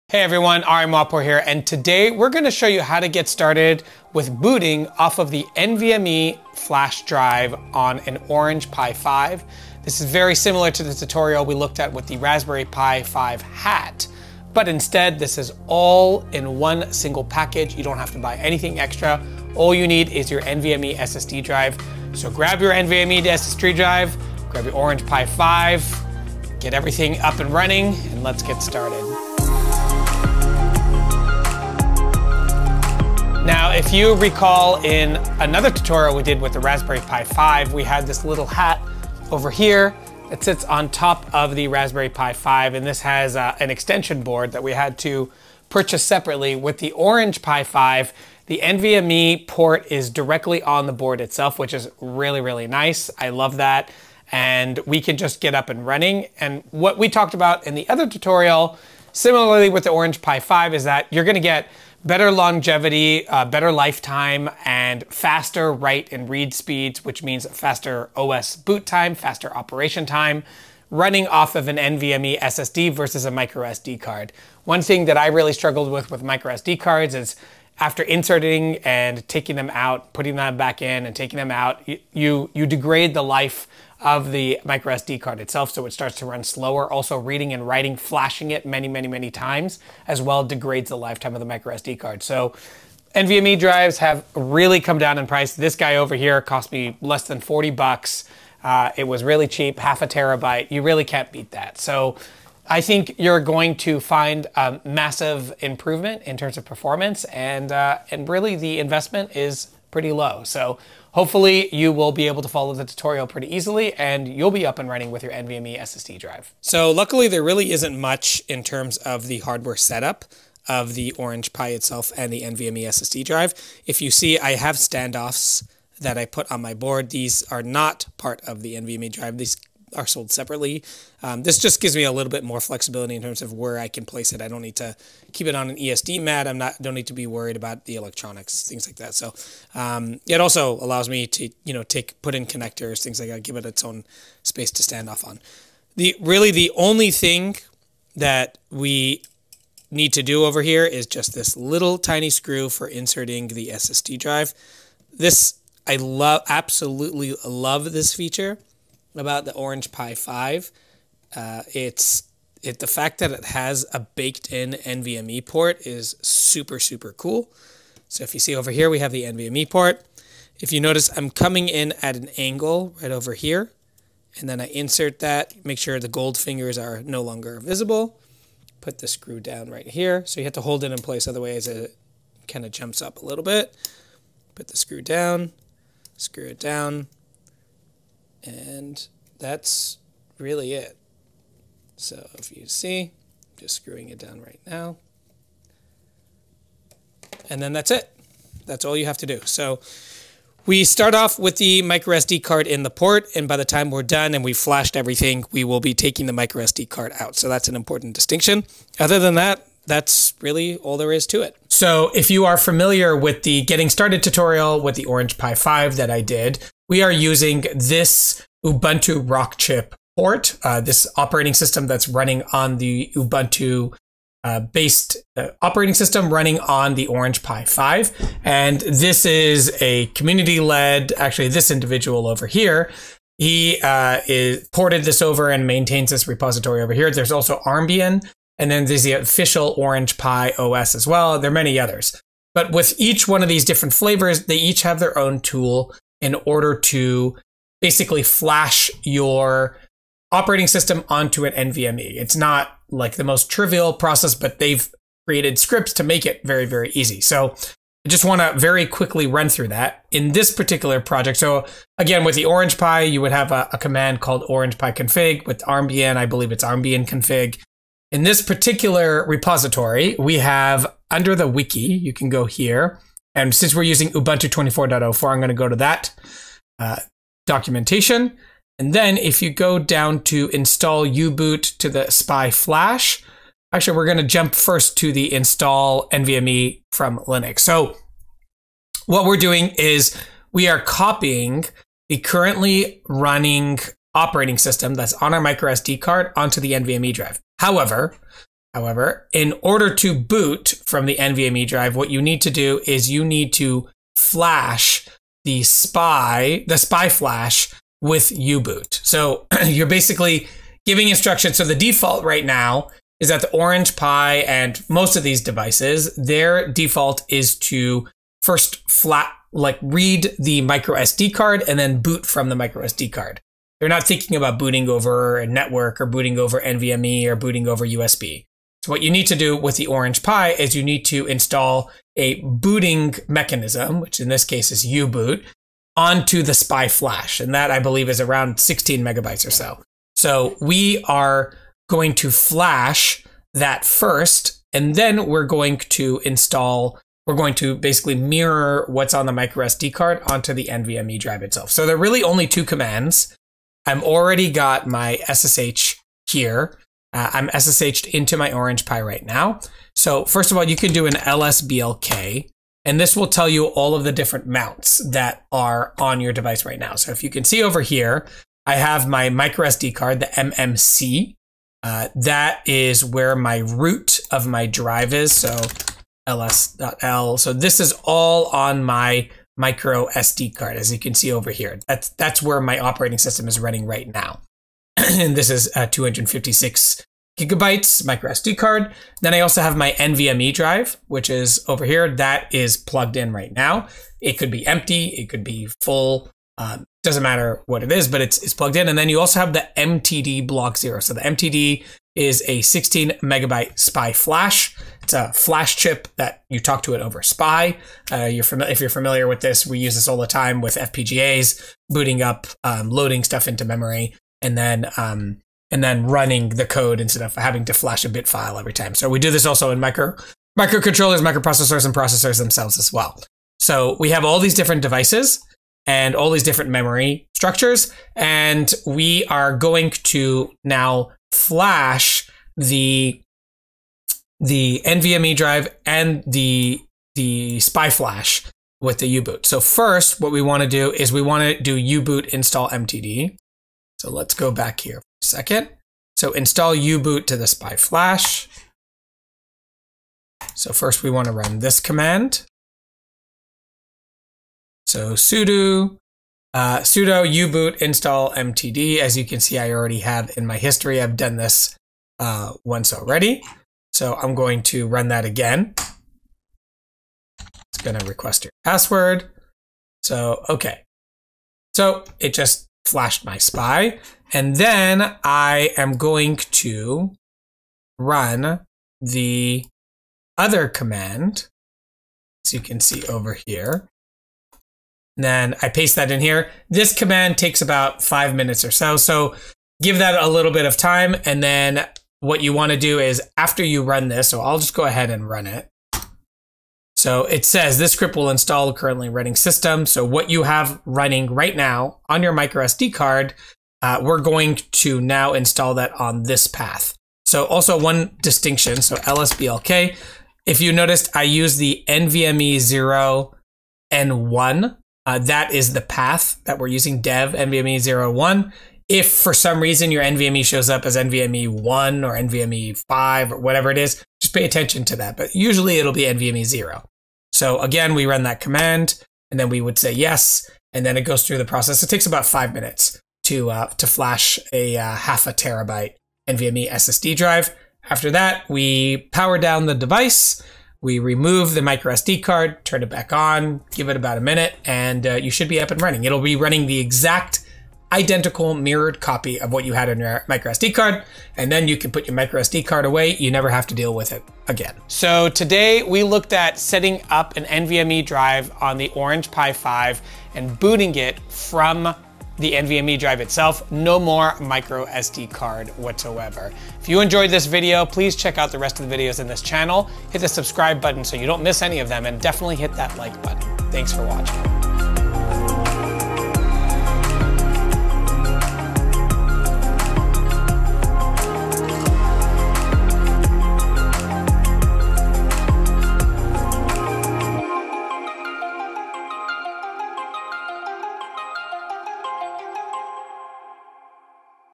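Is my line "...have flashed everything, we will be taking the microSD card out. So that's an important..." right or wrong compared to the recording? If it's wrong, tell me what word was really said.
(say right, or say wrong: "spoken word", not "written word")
right.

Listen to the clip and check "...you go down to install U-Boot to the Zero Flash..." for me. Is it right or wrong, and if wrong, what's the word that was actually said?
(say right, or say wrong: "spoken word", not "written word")
wrong: "SPI", not "Zero".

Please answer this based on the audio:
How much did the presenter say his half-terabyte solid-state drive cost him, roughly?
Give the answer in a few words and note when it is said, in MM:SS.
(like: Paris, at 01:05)
less than 40 bucks, at 01:36.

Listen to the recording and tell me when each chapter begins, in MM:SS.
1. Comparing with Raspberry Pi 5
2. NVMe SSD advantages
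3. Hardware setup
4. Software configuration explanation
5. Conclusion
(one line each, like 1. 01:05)
1. 00:33
2. 01:14
3. 01:56
4. 03:31
5. 09:14.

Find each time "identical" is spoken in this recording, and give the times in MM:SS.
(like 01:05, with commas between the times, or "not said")
09:07.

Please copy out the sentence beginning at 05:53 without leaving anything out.
I've already got my SSH here.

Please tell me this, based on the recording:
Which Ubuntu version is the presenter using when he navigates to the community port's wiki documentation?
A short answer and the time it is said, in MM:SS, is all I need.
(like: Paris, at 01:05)
24.04, at 04:34.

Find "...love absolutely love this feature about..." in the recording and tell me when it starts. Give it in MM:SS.
02:35.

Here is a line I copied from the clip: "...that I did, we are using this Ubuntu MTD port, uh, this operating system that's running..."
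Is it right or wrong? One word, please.
wrong.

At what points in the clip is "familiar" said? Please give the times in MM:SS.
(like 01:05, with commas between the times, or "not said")
03:32, 06:48.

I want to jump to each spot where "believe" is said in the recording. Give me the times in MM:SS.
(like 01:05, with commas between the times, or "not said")
04:26, 05:37.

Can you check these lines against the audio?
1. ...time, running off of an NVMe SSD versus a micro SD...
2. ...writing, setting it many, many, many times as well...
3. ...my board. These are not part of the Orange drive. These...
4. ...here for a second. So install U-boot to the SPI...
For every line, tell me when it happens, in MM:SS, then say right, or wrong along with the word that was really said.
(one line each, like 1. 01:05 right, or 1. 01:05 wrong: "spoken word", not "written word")
1. 01:10 right
2. 01:27 wrong: "flashing", not "setting"
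3. 02:06 wrong: "NVMe", not "Orange"
4. 07:24 right.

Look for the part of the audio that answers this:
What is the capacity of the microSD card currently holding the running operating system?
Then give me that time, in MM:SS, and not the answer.
06:25.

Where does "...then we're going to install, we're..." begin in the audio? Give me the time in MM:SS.
05:44.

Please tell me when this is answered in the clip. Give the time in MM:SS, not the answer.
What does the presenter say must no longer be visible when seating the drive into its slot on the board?
02:56.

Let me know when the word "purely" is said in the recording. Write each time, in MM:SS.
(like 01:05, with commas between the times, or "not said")
not said.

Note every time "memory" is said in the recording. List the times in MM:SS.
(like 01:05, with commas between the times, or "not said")
06:53, 07:06.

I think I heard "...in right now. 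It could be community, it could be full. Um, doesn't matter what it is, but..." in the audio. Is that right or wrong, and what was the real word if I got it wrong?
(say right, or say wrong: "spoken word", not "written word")
wrong: "empty", not "community".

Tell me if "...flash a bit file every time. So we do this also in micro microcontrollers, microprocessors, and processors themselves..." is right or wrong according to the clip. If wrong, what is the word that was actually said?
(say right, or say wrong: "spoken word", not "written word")
right.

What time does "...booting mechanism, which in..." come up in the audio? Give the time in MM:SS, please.
05:32.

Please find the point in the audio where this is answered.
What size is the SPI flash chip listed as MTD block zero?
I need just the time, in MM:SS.
06:42.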